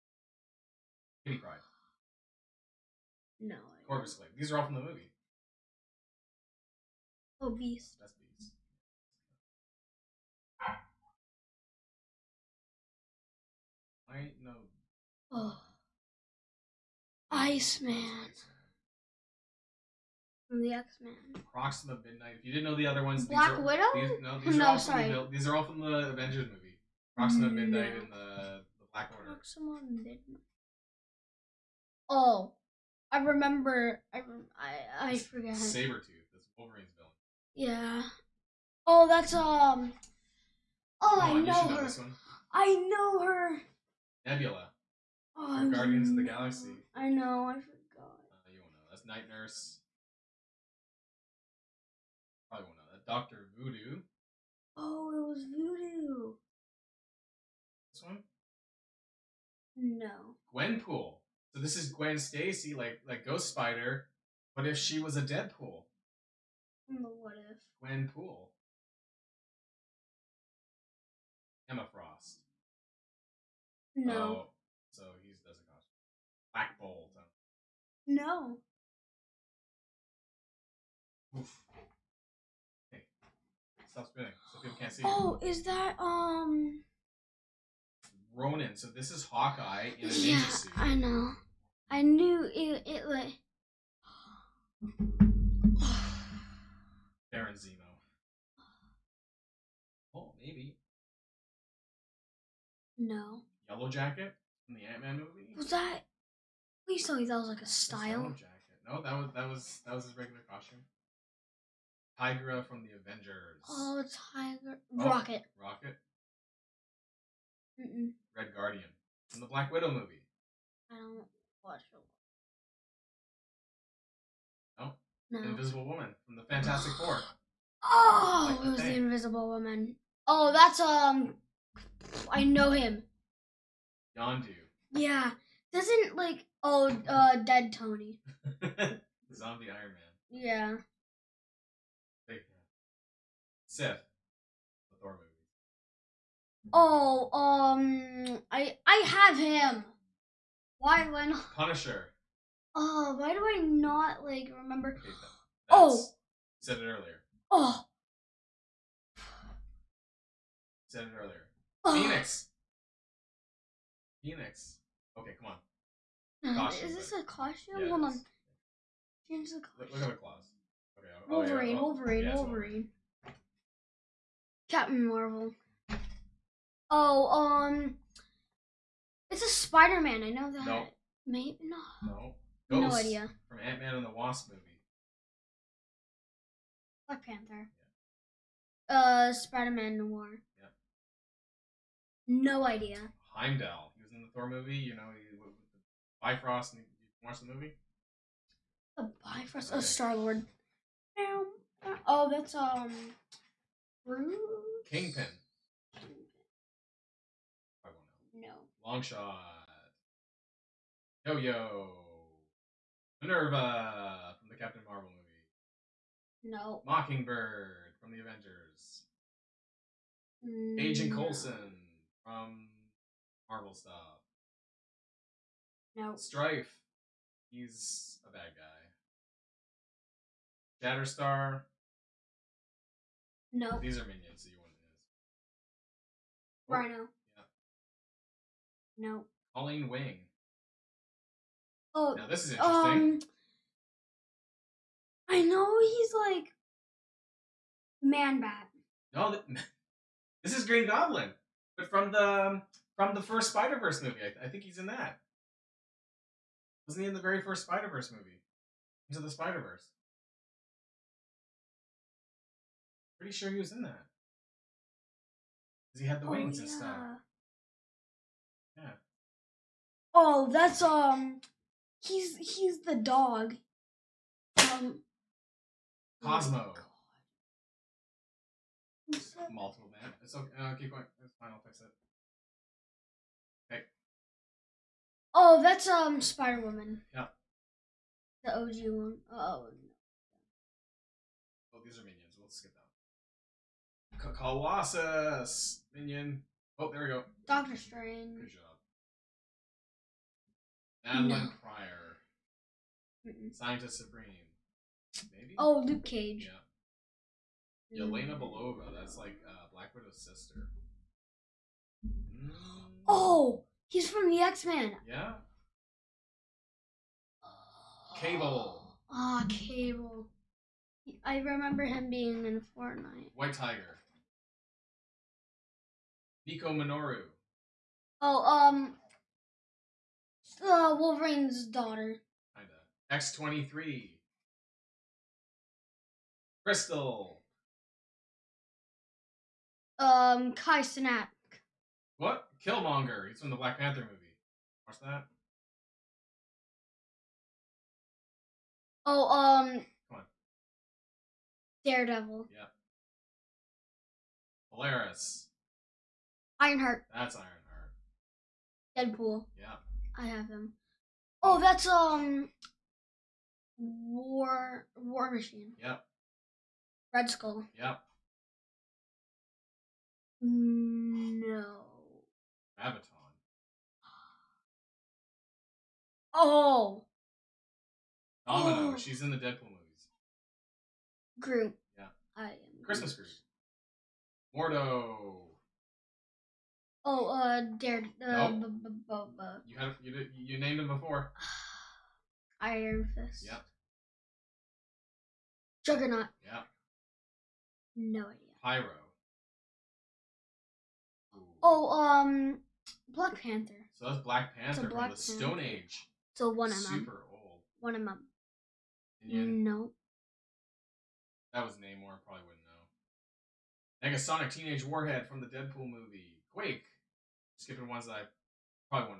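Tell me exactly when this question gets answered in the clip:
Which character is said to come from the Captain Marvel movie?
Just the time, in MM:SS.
03:33.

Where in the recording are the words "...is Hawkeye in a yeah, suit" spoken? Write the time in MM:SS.
01:29.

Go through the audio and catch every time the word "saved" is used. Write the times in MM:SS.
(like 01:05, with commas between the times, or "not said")
not said.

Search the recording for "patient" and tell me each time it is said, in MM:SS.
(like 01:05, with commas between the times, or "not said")
not said.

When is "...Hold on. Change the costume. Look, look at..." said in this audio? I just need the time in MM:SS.
02:47.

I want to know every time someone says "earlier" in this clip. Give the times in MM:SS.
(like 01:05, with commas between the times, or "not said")
02:36, 02:41.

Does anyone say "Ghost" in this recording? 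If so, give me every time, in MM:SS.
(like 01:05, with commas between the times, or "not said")
01:03, 03:02.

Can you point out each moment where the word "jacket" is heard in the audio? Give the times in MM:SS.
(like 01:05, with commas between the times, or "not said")
01:43, 01:48.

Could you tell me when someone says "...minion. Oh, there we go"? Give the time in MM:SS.
04:55.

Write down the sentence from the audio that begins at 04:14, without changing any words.
I, th- I think he's in that.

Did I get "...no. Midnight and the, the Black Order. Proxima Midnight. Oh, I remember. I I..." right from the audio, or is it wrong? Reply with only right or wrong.
right.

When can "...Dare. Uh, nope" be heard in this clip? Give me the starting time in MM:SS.
06:27.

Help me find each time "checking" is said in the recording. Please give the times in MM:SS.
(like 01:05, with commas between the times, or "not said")
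not said.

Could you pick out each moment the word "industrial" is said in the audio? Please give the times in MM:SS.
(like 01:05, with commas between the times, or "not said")
not said.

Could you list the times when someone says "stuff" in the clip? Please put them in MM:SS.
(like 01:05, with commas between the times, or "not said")
03:43, 04:26.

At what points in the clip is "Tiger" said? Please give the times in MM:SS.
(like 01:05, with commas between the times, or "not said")
01:54, 05:23.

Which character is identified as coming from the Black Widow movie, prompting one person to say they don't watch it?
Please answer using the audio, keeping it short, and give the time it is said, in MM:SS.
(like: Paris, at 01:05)
Red Guardian, at 01:58.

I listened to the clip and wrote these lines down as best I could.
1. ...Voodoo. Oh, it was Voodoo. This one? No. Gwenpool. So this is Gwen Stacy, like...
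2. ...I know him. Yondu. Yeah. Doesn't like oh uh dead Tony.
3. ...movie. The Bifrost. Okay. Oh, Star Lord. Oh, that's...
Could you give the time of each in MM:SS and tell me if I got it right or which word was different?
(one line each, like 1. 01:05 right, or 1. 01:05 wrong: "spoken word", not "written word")
1. 00:53 right
2. 02:12 right
3. 03:17 right.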